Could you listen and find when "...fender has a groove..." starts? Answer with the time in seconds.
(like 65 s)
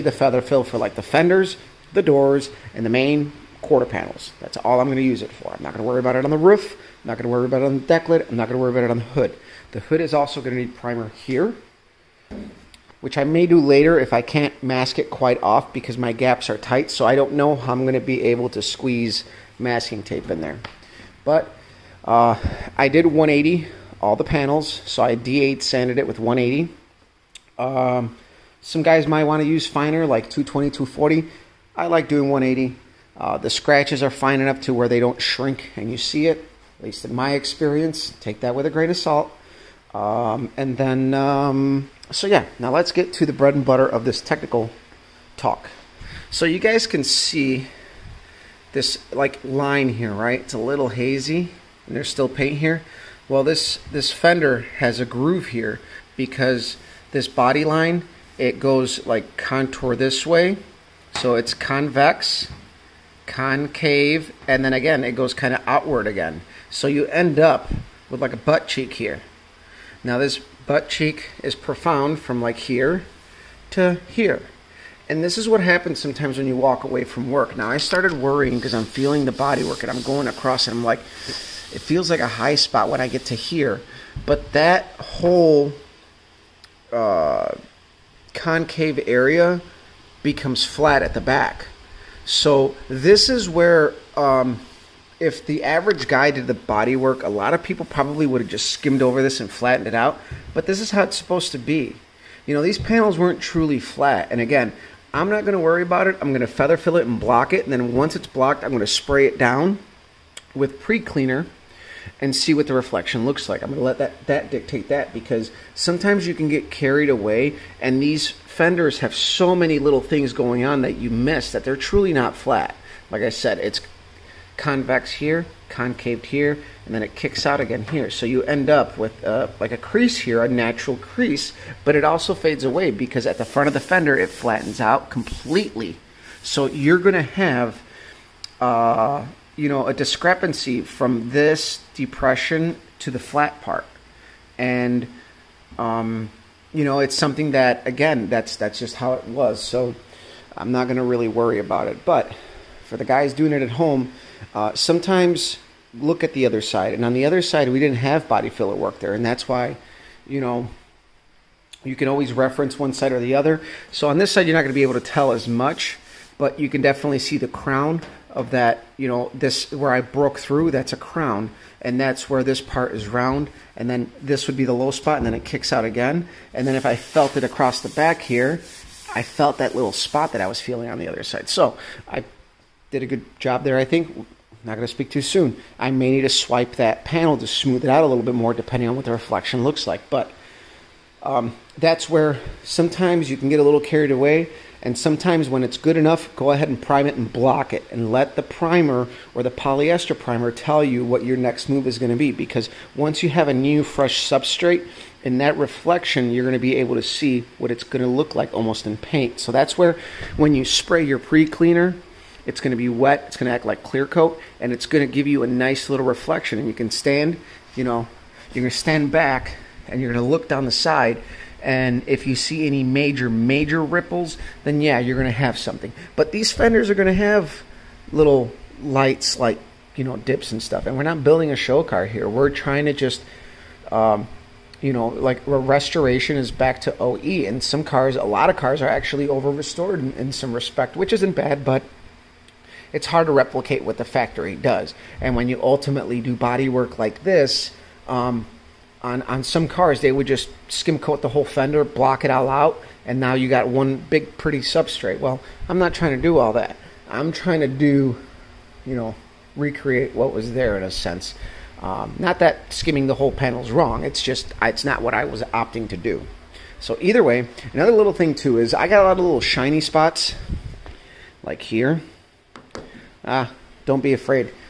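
54 s.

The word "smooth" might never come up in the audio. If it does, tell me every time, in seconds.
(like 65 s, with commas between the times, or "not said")
187 s.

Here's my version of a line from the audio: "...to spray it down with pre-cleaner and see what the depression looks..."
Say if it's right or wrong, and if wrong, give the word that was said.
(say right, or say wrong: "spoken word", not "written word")
wrong: "reflection", not "depression".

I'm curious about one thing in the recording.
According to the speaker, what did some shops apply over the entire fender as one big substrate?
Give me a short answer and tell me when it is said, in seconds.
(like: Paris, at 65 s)
skim coat, at 250 s.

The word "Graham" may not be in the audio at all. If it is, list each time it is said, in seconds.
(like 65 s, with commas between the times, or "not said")
not said.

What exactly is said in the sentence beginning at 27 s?
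Um, some guys might want to use finer, like 220, 240.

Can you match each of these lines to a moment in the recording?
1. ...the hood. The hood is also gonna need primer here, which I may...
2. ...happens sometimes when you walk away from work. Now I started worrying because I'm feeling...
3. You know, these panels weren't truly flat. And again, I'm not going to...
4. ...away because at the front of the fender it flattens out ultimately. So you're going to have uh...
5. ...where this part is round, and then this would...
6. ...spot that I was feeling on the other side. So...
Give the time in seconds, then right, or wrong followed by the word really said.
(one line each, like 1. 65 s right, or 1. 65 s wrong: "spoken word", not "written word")
1. 8 s right
2. 75 s right
3. 102 s right
4. 132 s wrong: "completely", not "ultimately"
5. 172 s right
6. 179 s right.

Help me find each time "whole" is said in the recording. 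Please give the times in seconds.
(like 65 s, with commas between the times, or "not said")
85 s, 251 s, 263 s.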